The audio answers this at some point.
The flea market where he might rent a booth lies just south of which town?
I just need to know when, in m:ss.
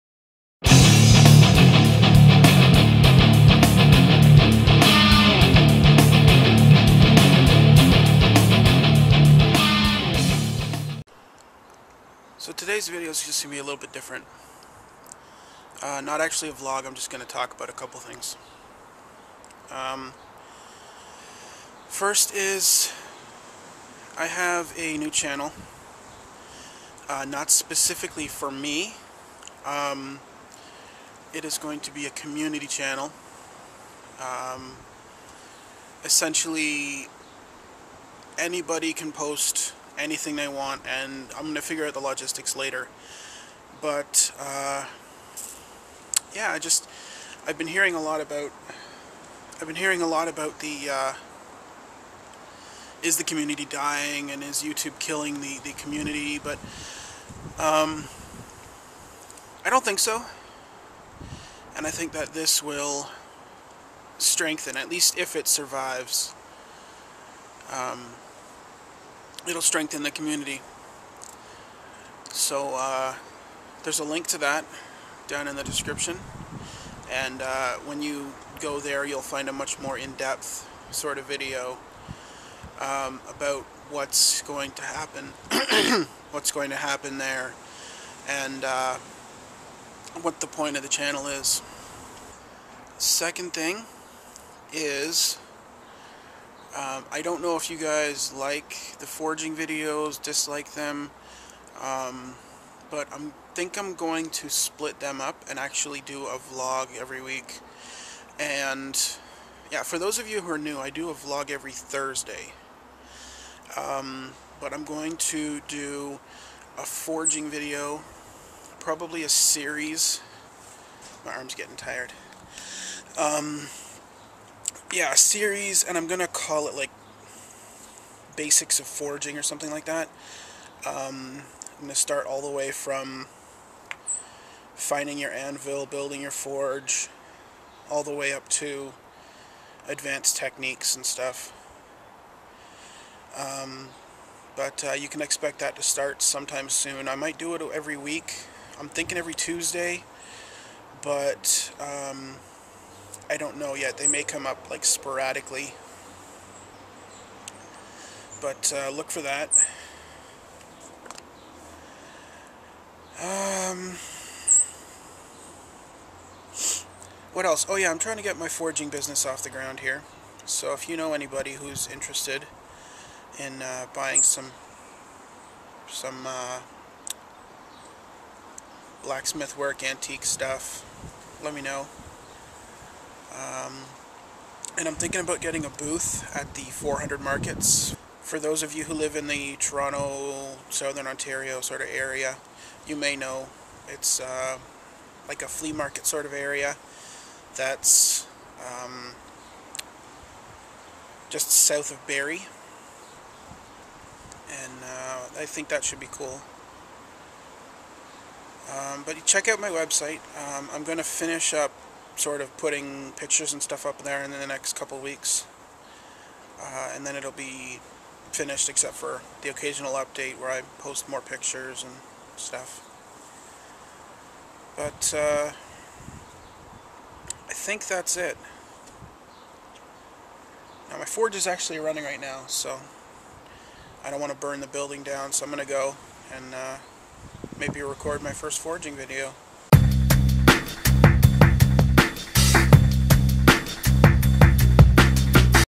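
3:22.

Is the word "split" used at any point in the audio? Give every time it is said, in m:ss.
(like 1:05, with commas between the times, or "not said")
1:44.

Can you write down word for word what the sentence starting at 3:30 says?
Um, I'm going to finish up sort of putting pictures and stuff up there in the next couple weeks.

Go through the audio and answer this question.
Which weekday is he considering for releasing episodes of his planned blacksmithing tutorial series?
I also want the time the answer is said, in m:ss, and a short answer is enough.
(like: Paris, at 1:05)
Tuesday, at 2:29.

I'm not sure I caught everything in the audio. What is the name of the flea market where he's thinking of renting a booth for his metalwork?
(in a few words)
400 markets.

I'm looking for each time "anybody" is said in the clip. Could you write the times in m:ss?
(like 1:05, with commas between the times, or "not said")
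0:38, 2:51.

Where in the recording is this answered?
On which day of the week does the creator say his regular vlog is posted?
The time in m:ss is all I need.
1:51.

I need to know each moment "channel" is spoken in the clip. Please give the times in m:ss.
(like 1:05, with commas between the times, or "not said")
0:25, 0:32, 1:30.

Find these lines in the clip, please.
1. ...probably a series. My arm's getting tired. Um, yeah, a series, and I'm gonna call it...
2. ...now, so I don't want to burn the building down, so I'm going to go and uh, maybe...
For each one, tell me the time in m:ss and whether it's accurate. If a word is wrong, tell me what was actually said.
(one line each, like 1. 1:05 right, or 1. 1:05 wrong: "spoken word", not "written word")
1. 1:58 right
2. 3:52 right.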